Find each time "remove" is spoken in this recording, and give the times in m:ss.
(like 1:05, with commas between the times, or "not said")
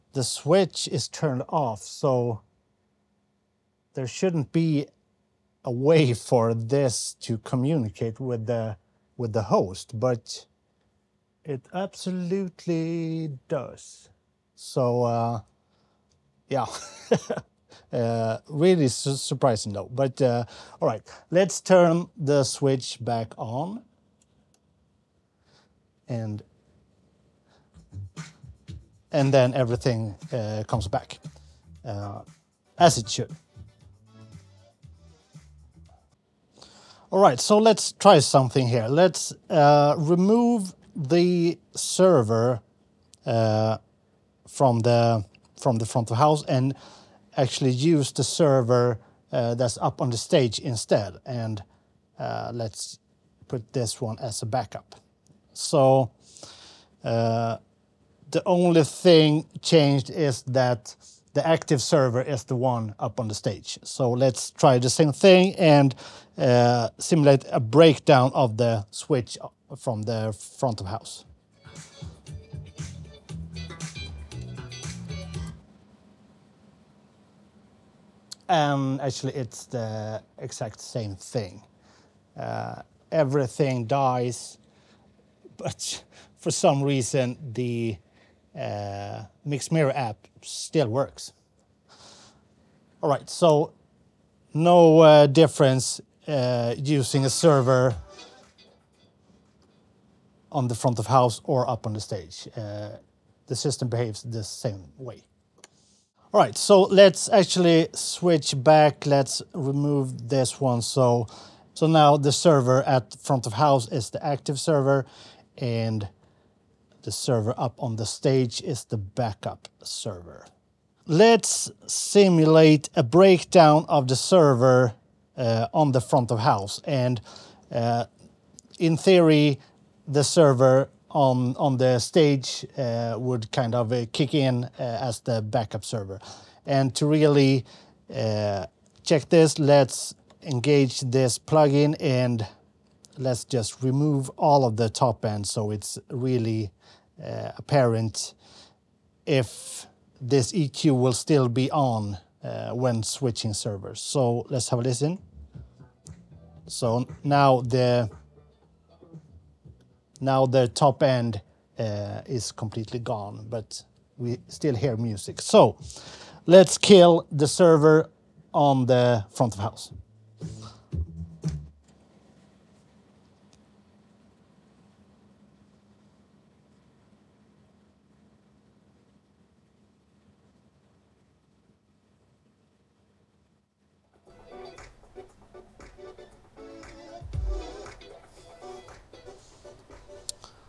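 0:39, 1:49, 2:23.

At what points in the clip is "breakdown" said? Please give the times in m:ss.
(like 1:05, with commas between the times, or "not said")
1:07, 2:03.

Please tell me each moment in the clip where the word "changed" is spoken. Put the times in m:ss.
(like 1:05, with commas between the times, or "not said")
0:59.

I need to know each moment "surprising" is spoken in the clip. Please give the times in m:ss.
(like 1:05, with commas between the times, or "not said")
0:19.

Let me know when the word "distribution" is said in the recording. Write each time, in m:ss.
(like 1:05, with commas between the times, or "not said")
not said.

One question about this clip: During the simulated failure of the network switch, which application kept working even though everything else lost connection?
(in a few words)
Mixed Mirror.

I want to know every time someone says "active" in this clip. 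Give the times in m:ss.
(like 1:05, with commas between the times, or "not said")
1:01, 1:54.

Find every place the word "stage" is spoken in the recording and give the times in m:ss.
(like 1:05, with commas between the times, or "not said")
0:50, 1:03, 1:41, 1:58, 2:11.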